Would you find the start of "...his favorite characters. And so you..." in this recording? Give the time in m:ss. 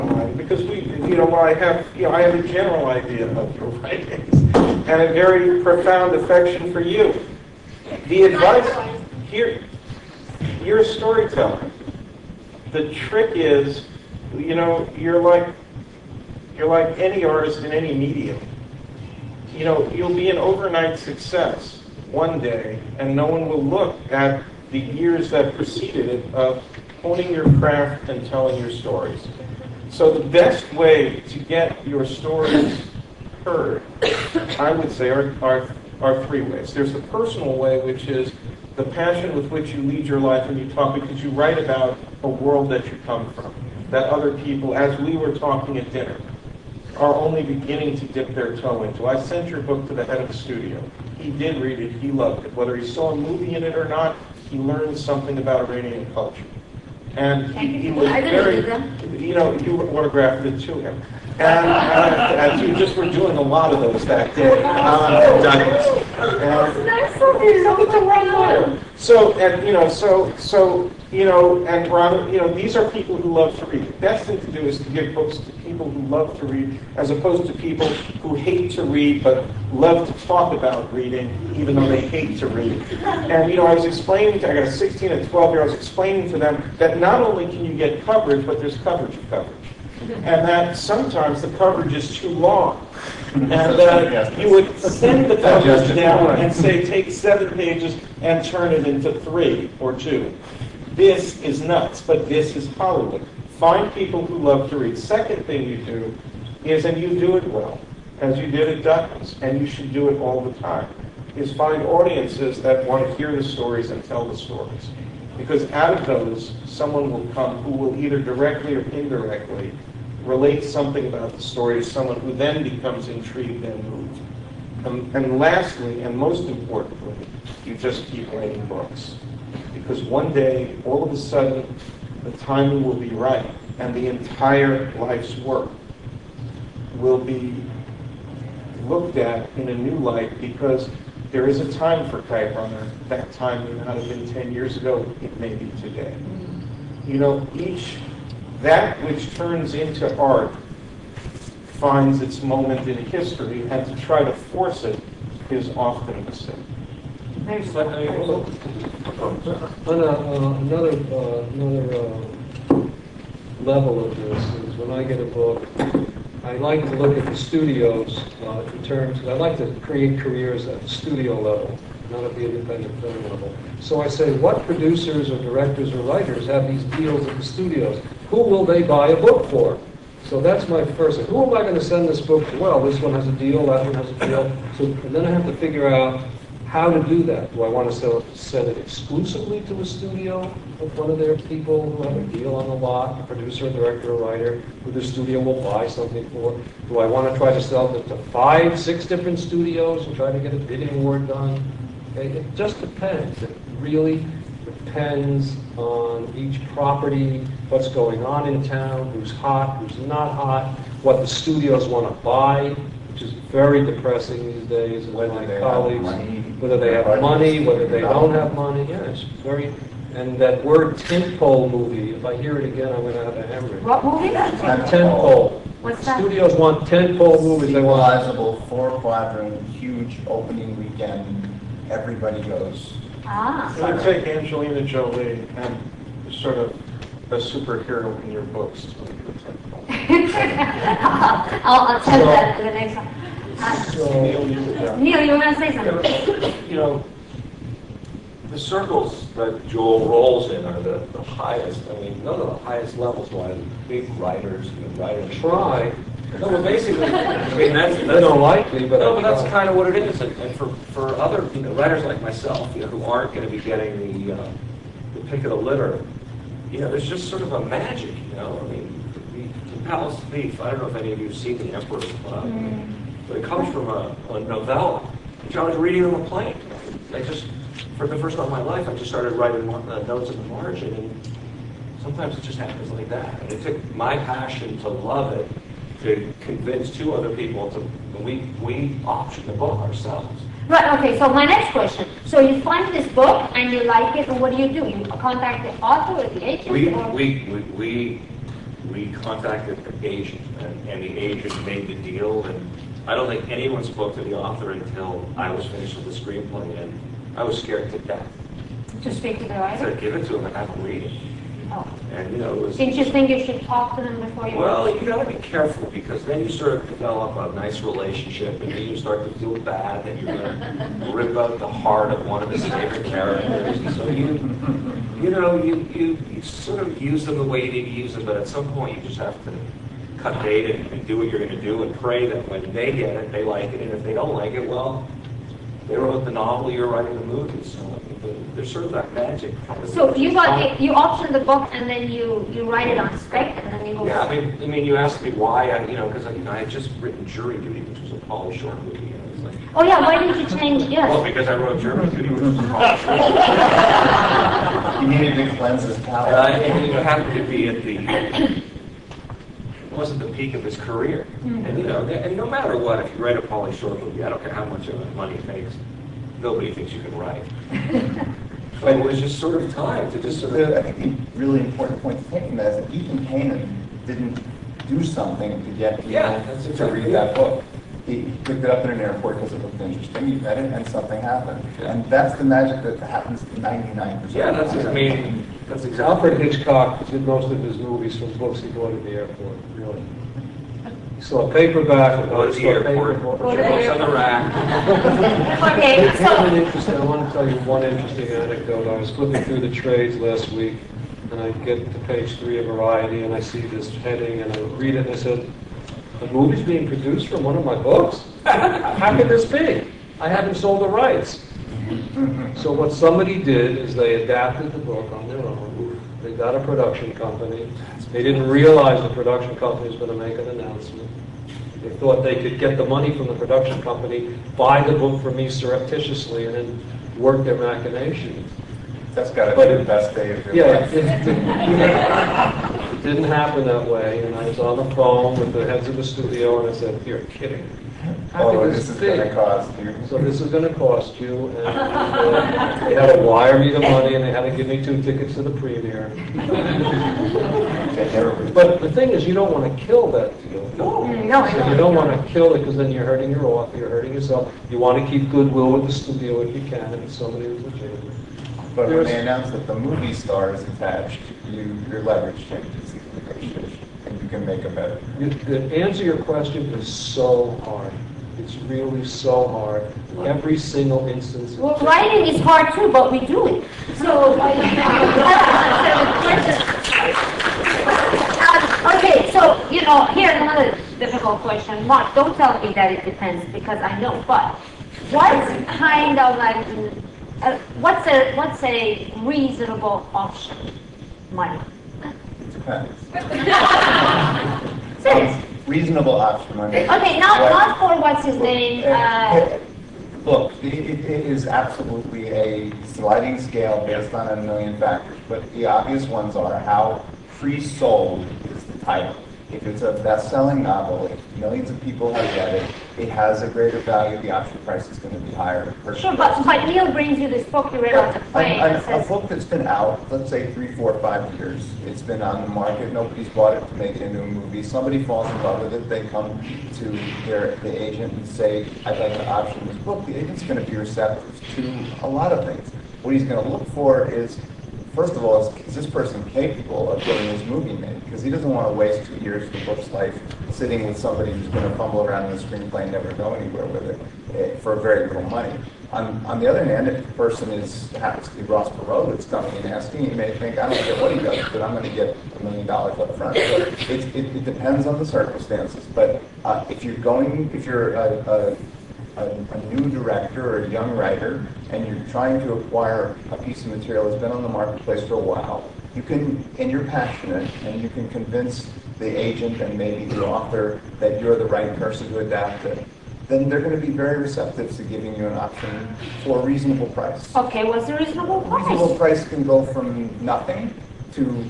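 5:22.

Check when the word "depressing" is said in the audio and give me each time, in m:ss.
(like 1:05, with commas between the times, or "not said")
3:33.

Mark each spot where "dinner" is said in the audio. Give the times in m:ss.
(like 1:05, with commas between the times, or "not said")
0:45.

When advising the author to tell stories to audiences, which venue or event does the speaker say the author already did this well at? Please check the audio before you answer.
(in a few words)
Douglas.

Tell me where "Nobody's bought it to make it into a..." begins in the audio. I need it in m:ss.
8:42.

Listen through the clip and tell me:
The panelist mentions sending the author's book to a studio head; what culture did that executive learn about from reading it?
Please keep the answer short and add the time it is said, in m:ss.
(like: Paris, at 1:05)
Iranian culture, at 0:55.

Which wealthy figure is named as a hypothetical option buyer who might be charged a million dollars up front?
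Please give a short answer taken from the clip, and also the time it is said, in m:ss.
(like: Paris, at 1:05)
Ross Perot, at 9:08.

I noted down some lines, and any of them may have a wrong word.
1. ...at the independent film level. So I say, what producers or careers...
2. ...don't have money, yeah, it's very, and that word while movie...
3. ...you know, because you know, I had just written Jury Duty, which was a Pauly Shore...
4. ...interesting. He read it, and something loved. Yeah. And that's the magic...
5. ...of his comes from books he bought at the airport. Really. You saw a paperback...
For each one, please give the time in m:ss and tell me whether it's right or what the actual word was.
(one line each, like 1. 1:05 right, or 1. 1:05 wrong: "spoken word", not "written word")
1. 2:52 wrong: "directors", not "careers"
2. 3:38 wrong: "tentpole", not "while"
3. 5:45 right
4. 6:19 wrong: "happened", not "loved"
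5. 6:27 wrong: "movies", not "comes".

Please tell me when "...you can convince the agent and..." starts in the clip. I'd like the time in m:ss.
9:27.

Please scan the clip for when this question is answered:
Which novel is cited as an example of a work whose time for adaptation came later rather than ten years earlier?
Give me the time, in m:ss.
2:22.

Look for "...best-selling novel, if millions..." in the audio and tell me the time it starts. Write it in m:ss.
8:30.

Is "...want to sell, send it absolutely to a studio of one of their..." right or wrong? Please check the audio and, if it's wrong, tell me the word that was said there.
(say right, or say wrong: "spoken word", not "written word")
wrong: "exclusively", not "absolutely".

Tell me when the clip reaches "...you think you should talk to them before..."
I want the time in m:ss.
5:12.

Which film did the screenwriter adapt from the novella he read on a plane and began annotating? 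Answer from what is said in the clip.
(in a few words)
The Emperor's Club.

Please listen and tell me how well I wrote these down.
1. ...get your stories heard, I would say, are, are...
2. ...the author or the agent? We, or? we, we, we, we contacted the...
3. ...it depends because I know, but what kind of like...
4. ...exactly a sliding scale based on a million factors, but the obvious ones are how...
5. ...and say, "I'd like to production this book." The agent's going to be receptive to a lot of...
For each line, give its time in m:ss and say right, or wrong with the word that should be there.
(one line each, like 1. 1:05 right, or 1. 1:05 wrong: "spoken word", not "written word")
1. 0:31 right
2. 4:55 right
3. 8:02 right
4. 8:21 wrong: "absolutely", not "exactly"
5. 8:48 wrong: "option", not "production".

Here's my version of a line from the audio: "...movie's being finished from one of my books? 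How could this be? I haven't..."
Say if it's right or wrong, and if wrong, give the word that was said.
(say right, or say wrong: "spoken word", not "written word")
wrong: "produced", not "finished".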